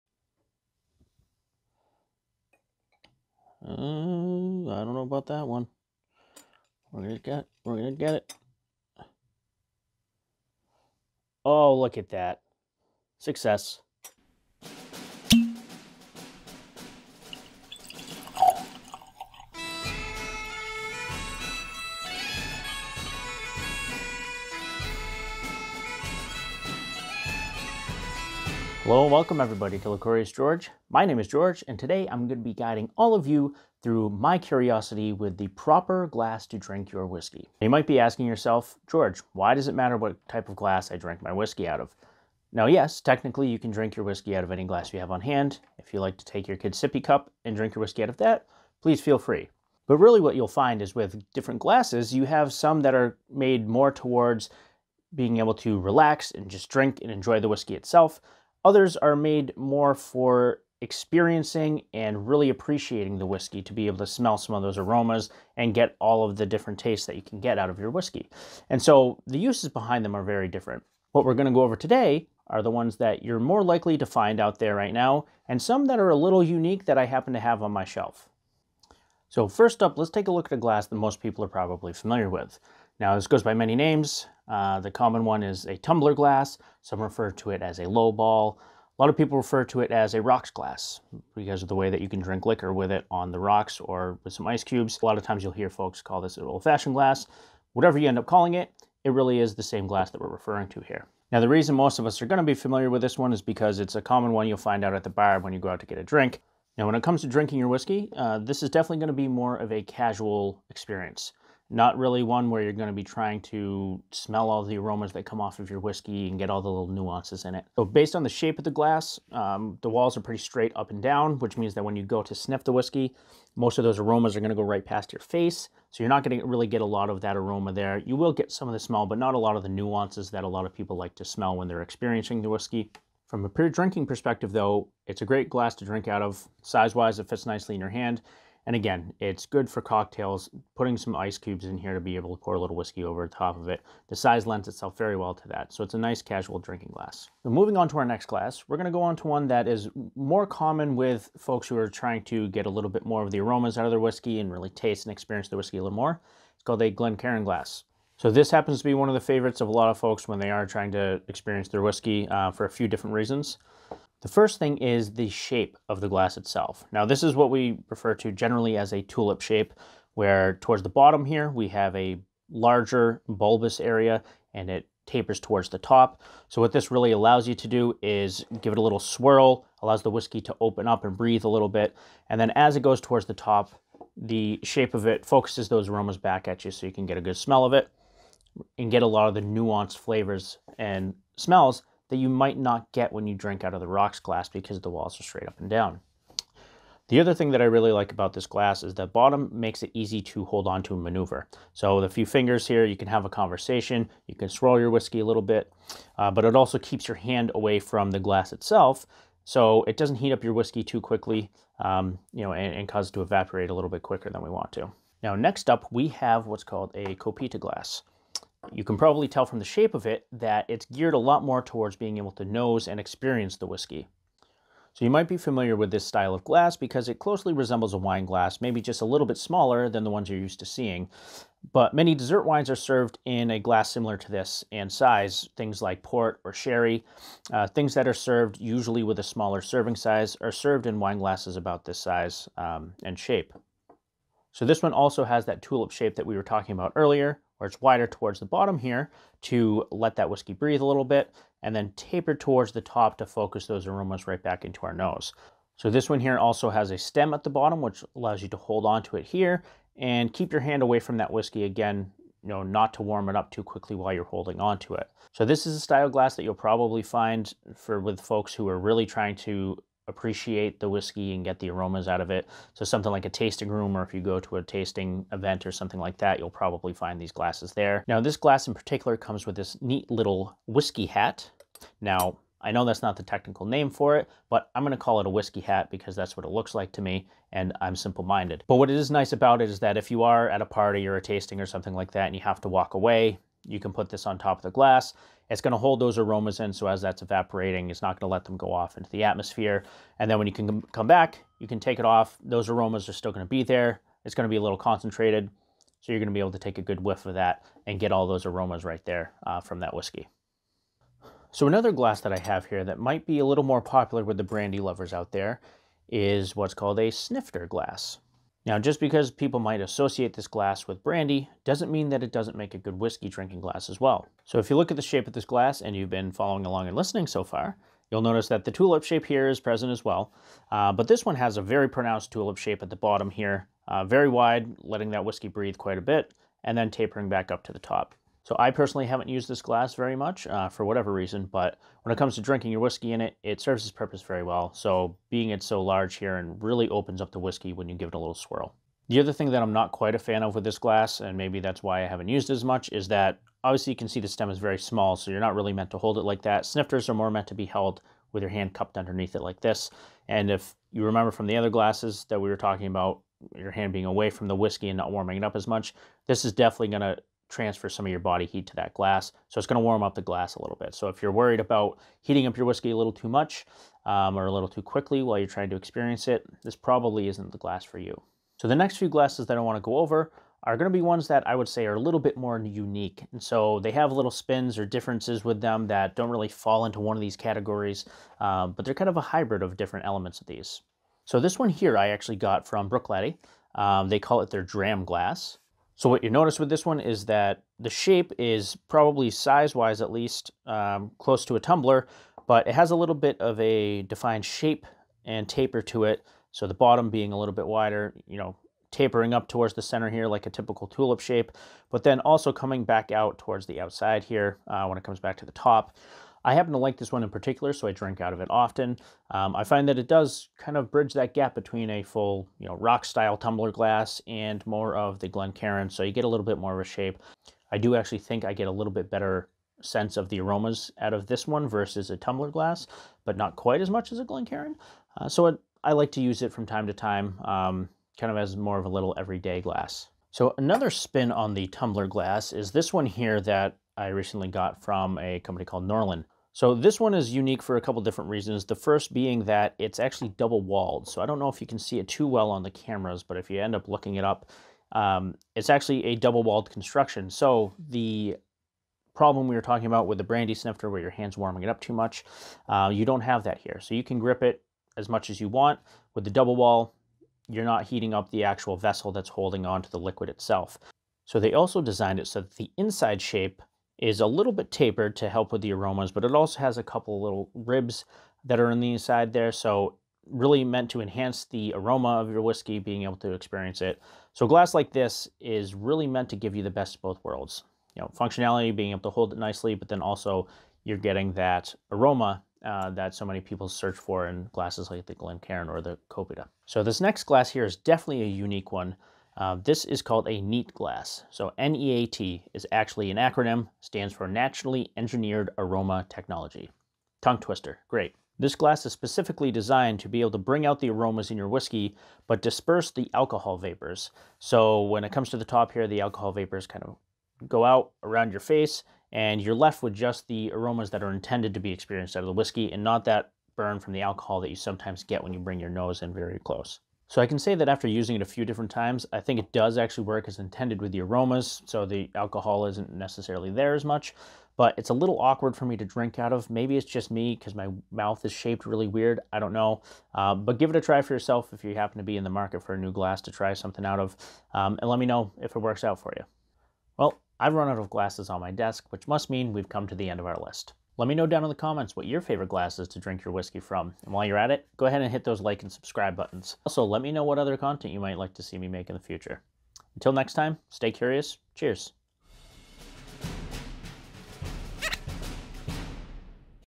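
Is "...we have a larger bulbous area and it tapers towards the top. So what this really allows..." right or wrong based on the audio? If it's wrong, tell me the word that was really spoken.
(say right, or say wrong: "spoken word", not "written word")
right.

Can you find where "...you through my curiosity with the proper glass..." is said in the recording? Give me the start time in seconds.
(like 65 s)
33 s.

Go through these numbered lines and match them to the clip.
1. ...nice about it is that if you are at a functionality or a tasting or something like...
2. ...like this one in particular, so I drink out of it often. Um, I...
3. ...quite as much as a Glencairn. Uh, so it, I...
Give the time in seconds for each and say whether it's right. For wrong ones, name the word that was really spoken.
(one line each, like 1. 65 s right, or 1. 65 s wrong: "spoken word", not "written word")
1. 289 s wrong: "party", not "functionality"
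2. 416 s right
3. 433 s right.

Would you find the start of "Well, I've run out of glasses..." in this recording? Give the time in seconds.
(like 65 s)
546 s.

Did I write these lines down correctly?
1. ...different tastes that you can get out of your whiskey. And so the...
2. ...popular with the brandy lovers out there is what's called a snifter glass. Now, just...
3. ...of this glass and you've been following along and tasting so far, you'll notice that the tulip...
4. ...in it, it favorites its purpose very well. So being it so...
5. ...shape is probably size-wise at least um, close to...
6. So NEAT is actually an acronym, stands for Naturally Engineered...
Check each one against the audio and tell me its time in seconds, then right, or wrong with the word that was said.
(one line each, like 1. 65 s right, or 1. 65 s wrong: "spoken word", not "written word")
1. 66 s right
2. 313 s right
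3. 325 s wrong: "listening", not "tasting"
4. 343 s wrong: "serves", not "favorites"
5. 397 s right
6. 501 s right.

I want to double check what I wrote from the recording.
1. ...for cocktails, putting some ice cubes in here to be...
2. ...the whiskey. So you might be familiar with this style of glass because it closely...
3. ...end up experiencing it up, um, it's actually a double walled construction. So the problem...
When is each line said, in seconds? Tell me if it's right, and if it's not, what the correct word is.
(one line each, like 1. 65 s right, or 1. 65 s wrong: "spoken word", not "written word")
1. 139 s right
2. 223 s right
3. 453 s wrong: "looking", not "experiencing".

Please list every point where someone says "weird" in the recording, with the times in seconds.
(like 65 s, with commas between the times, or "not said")
538 s.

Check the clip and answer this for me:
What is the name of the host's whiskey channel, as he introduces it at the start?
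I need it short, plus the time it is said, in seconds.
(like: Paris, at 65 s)
Liquorious George, at 29 s.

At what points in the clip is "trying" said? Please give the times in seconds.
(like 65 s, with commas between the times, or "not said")
113 s, 151 s, 160 s, 269 s, 375 s.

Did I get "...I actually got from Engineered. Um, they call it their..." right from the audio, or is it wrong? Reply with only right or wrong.
wrong.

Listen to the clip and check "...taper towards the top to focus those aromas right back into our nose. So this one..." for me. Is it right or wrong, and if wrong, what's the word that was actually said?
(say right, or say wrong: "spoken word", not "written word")
right.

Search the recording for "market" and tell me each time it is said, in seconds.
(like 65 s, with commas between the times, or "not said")
542 s.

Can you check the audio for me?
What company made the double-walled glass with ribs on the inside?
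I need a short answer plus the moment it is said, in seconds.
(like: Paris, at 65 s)
Norlan, at 445 s.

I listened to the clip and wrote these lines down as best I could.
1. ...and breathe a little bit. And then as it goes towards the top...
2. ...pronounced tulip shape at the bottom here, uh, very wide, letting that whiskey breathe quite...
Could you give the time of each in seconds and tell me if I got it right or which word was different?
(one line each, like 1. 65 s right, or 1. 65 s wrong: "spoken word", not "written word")
1. 181 s right
2. 331 s right.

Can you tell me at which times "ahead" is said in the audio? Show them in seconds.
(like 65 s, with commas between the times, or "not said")
554 s.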